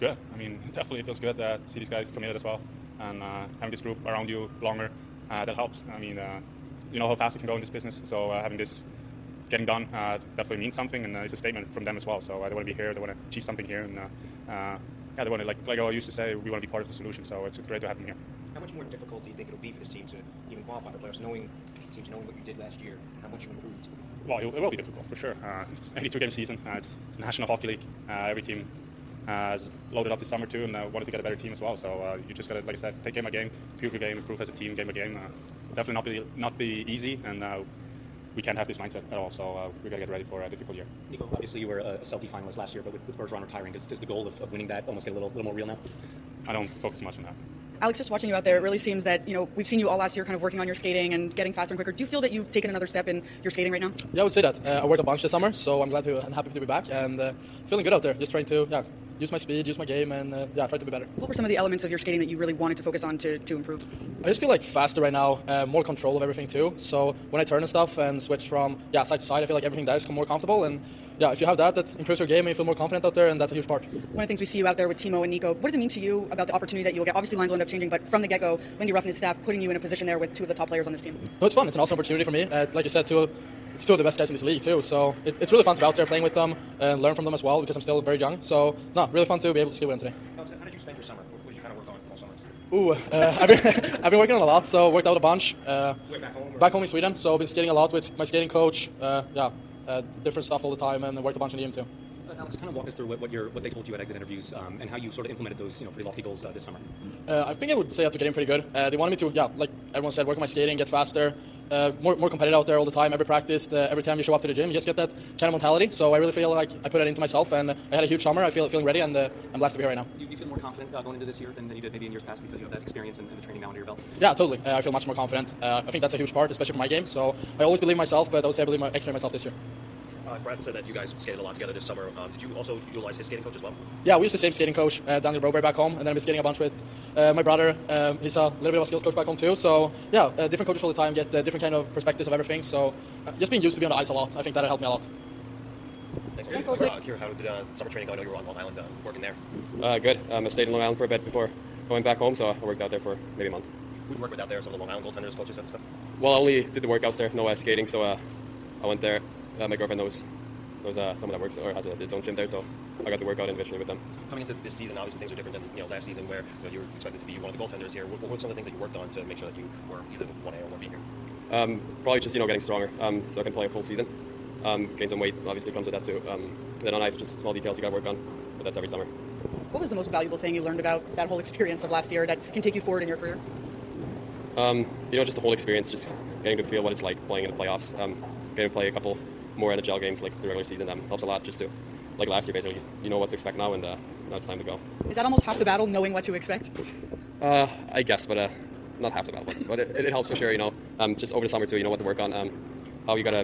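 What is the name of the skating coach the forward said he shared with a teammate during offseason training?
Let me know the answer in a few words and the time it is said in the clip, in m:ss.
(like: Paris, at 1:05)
Daniel Broberg, at 2:15.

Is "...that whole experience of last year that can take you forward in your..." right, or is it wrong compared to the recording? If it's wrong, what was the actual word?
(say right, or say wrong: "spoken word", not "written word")
right.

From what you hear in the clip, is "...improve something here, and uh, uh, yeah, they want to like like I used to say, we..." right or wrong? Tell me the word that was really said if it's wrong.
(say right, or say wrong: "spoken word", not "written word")
wrong: "achieve", not "improve".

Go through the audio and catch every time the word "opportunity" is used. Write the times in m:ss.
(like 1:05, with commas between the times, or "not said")
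1:16, 1:21.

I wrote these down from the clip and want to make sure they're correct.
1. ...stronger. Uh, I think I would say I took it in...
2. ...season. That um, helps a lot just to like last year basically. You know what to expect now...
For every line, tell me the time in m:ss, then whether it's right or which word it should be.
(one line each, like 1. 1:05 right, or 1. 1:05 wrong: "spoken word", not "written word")
1. 1:46 wrong: "summer", not "stronger"
2. 3:10 right.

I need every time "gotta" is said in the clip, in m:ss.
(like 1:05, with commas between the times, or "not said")
0:32, 0:39.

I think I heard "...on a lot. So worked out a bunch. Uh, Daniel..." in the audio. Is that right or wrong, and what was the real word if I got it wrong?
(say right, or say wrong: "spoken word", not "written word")
wrong: "Where", not "Daniel".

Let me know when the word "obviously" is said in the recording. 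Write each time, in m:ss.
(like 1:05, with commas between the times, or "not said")
0:41, 1:17, 2:44, 2:55.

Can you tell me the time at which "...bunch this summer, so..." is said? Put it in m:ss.
0:55.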